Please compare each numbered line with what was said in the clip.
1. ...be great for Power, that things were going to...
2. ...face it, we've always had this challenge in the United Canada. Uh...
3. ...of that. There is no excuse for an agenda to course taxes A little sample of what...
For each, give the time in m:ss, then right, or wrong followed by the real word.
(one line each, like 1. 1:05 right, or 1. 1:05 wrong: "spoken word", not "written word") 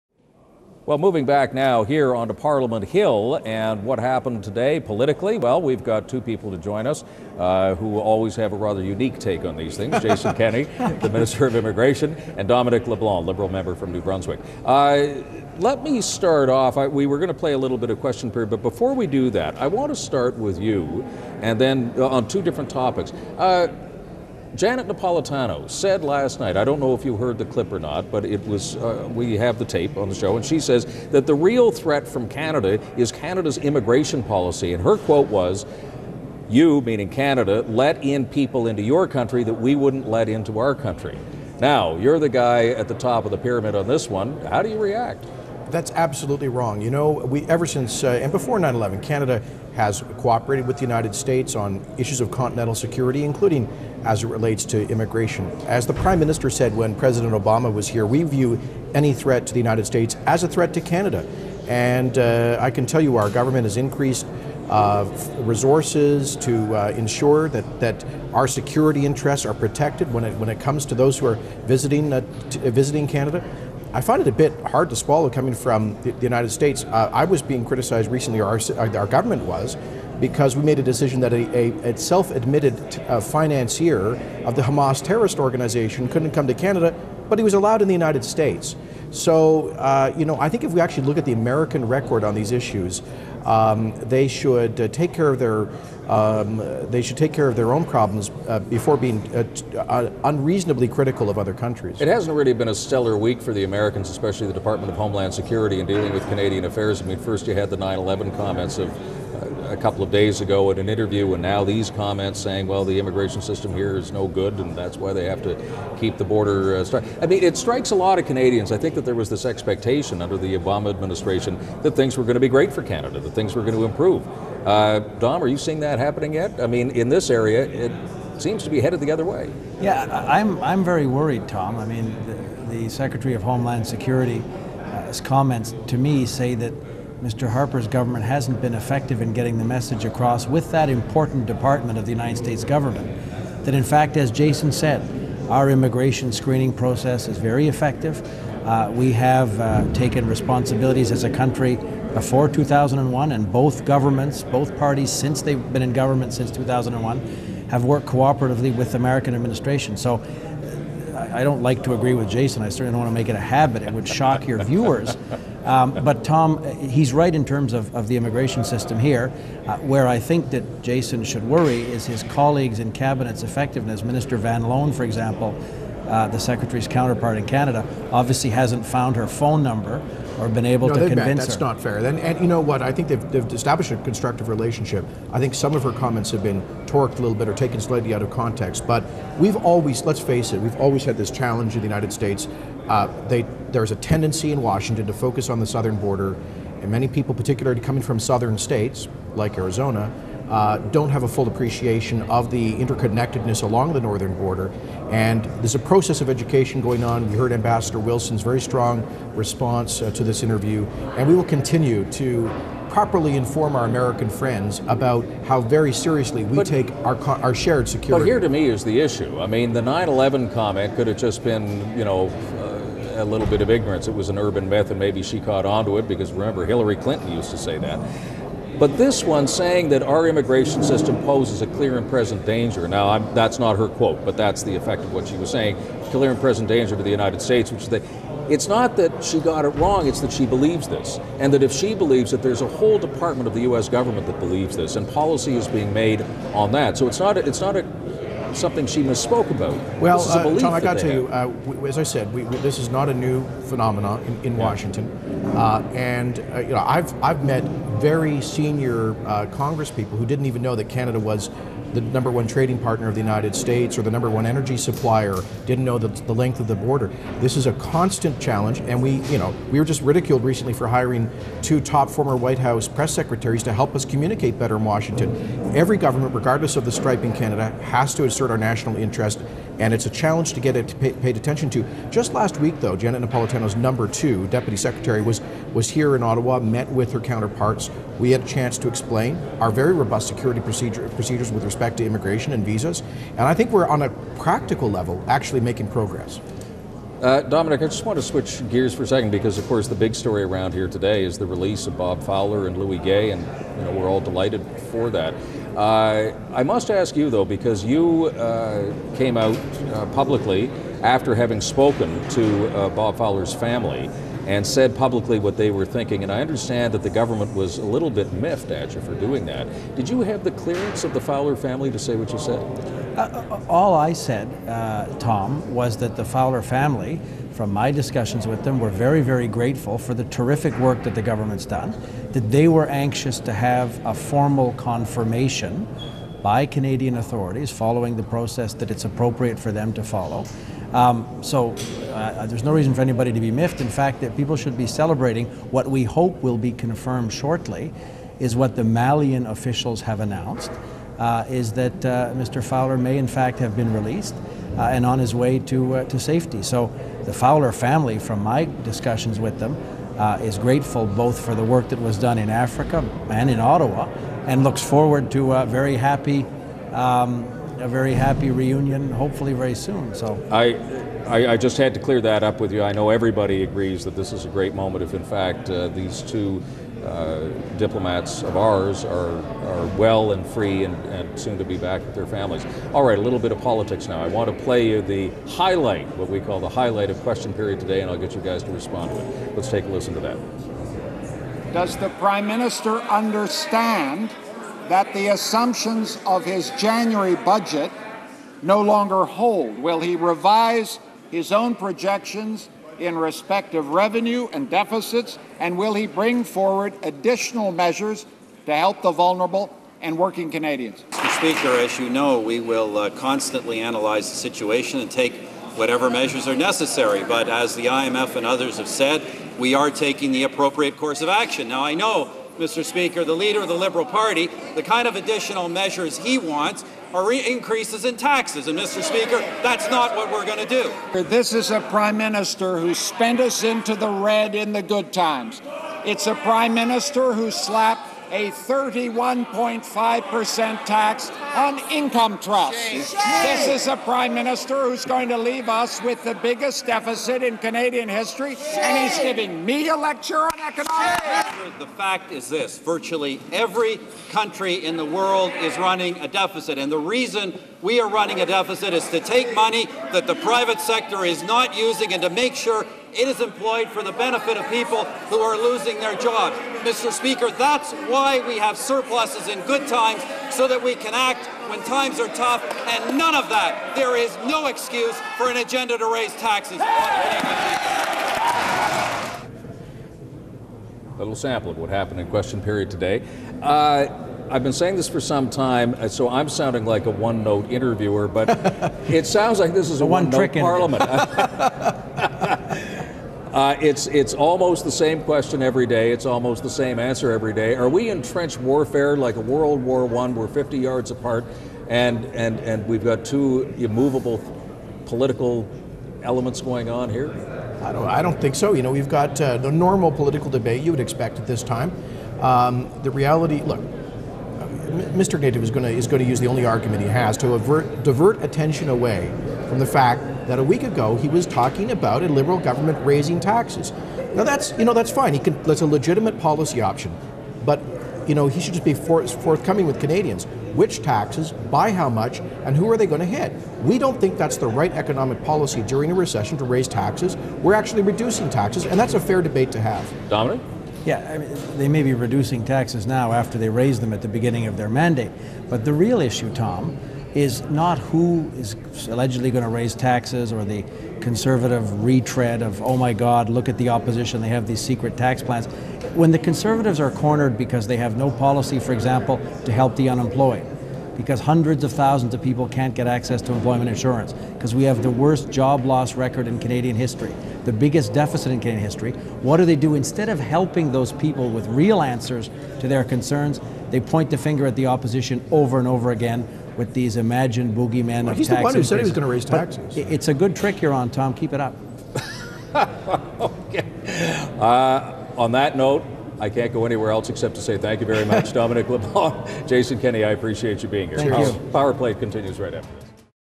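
1. 2:02 wrong: "Canada", not "Power"
2. 3:10 wrong: "States", not "Canada"
3. 7:53 wrong: "raise", not "course".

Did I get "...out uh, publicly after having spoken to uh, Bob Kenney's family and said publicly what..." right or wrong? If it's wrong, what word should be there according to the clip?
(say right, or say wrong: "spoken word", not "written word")
wrong: "Fowler", not "Kenney".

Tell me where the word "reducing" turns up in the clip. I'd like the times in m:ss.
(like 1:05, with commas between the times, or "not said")
8:58, 9:02.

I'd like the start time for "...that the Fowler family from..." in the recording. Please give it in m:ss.
5:25.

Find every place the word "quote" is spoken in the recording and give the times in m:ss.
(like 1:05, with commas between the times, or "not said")
0:34, 3:53.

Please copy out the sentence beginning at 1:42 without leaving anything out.
It hasn't really been a stellar week for the Americans, especially the Department of Homeland Security in dealing with Canadian affairs.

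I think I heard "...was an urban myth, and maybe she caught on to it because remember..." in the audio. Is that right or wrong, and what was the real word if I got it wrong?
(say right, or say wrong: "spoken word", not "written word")
right.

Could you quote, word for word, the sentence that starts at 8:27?
I don't I don't think so.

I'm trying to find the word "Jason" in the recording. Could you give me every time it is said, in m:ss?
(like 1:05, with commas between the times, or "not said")
0:10, 2:24, 2:42, 2:50, 9:49.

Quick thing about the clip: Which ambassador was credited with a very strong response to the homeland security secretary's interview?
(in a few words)
Ambassador Wilson.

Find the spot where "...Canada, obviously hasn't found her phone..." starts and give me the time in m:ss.
2:57.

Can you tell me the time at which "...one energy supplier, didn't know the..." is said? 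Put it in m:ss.
4:24.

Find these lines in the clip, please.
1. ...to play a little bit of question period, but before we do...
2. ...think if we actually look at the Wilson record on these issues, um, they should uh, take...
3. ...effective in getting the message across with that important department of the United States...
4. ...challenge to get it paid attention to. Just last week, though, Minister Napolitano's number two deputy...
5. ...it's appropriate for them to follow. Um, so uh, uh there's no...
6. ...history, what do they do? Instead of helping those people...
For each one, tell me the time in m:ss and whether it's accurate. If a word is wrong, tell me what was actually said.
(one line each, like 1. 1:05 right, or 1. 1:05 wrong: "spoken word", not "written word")
1. 0:17 right
2. 1:30 wrong: "American", not "Wilson"
3. 2:18 right
4. 4:40 wrong: "Janet", not "Minister"
5. 5:38 right
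6. 9:28 right.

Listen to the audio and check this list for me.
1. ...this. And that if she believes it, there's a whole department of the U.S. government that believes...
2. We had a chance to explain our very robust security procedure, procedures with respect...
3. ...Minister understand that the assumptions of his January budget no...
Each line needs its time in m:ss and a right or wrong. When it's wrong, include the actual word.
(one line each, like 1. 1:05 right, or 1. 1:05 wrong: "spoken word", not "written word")
1. 4:00 right
2. 4:48 right
3. 6:32 right.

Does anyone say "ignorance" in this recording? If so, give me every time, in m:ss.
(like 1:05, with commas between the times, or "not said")
3:43.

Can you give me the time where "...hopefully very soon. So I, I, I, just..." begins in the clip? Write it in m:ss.
6:09.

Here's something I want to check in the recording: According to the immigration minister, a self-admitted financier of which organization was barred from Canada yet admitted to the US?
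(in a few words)
Hamas.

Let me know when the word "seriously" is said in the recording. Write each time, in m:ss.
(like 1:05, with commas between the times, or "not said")
3:35.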